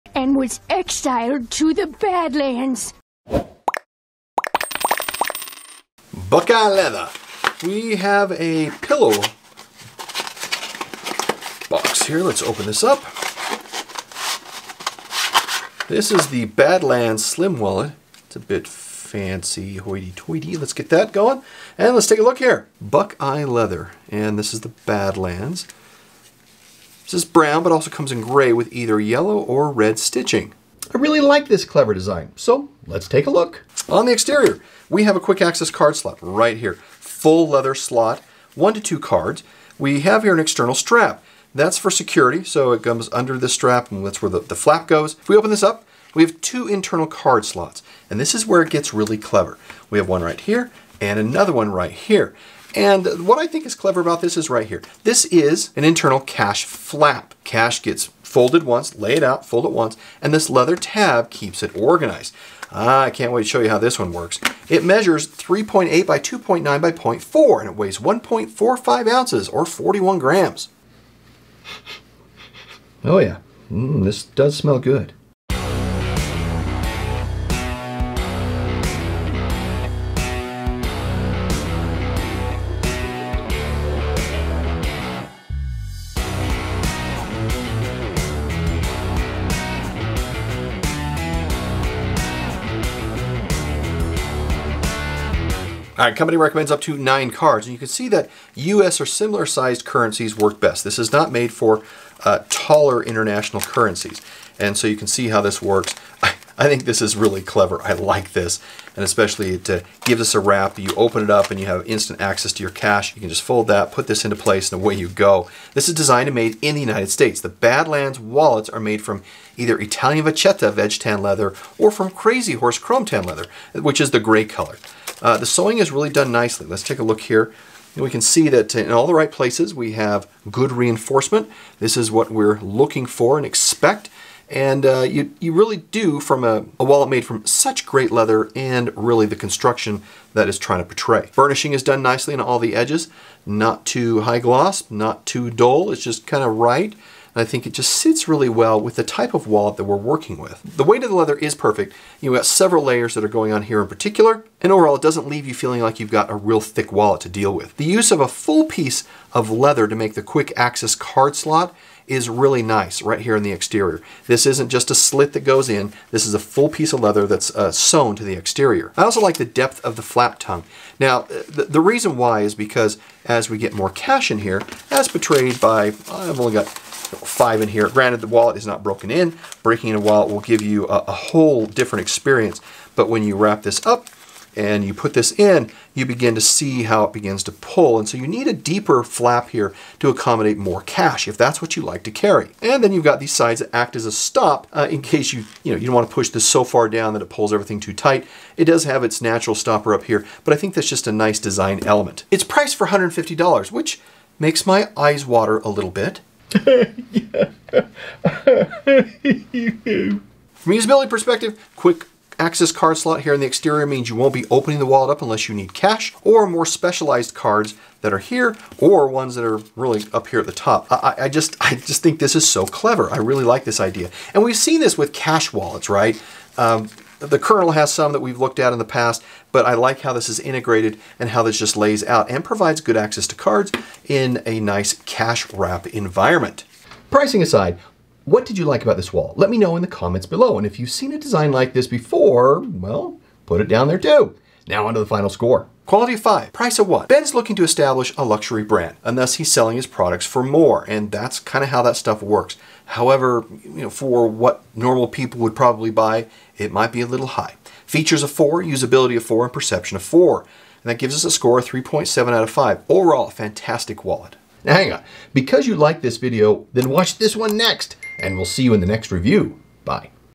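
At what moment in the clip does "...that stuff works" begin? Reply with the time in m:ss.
4:11.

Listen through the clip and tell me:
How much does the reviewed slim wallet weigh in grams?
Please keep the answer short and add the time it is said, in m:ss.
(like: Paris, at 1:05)
41 grams, at 1:09.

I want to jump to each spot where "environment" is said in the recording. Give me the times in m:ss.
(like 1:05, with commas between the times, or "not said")
3:55.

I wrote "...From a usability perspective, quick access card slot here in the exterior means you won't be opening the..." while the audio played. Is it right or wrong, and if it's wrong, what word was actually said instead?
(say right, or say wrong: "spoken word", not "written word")
right.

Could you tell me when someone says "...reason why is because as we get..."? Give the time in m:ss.
2:51.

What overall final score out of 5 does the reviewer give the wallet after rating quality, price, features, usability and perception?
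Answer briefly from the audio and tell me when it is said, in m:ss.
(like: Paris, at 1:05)
3.7, at 4:21.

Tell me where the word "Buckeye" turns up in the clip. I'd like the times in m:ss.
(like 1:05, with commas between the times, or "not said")
0:06, 0:22.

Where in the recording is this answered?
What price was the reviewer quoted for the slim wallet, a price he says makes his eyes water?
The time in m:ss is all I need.
3:22.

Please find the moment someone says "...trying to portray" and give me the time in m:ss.
2:20.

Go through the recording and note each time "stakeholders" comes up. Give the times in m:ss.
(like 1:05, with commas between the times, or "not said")
not said.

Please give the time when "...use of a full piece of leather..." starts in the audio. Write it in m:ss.
2:37.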